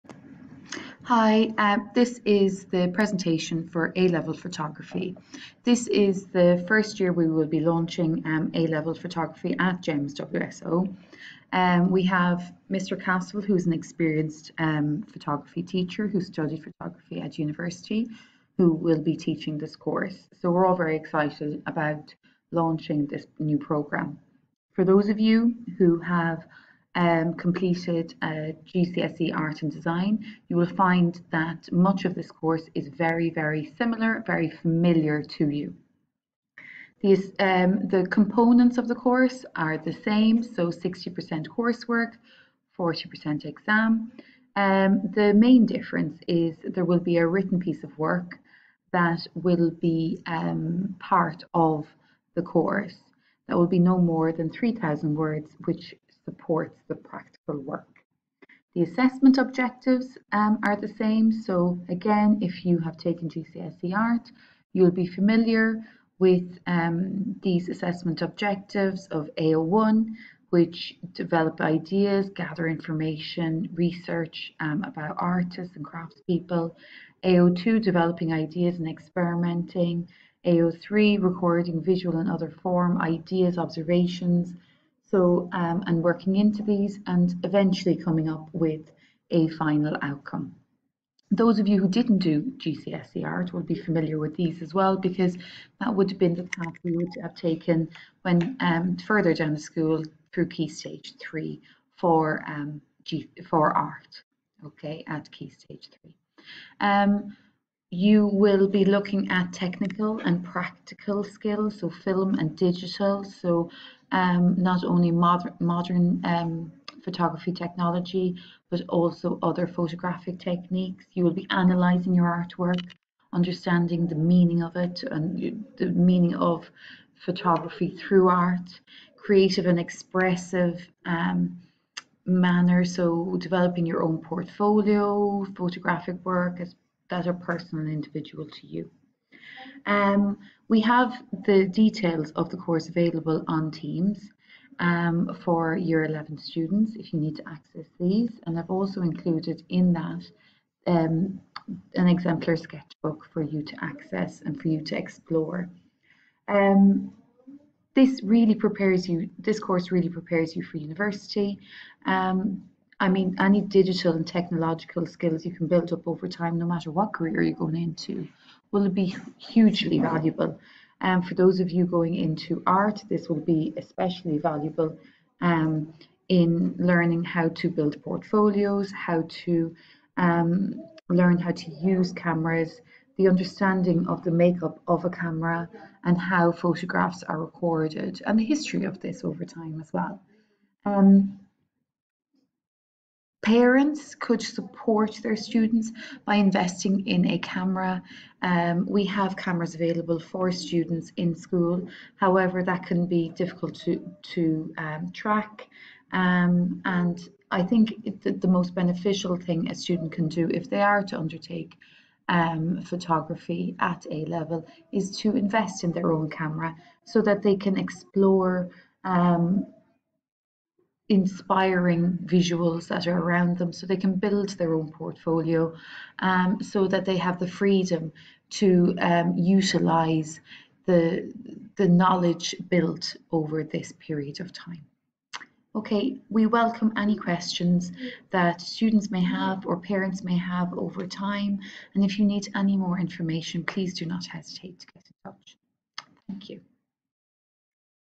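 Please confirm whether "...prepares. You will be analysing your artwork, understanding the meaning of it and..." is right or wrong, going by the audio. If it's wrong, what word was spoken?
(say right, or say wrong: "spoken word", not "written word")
wrong: "techniques", not "prepares".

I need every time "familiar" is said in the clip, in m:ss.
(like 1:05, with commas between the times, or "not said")
0:34, 1:05, 1:33.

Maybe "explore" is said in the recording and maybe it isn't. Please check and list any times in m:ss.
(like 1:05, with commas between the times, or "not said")
2:34, 3:37.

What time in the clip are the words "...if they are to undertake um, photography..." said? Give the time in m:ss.
3:30.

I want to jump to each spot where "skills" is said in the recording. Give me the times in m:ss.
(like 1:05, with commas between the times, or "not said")
1:51, 2:45.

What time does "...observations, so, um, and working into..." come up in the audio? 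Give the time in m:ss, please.
1:23.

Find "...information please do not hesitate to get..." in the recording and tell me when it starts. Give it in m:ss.
4:02.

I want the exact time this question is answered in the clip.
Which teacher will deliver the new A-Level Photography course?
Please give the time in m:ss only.
0:12.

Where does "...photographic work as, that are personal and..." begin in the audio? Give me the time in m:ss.
2:15.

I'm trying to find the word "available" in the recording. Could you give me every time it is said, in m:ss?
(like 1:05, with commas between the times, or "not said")
2:22, 3:19.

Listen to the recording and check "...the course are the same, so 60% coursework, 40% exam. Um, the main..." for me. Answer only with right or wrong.
right.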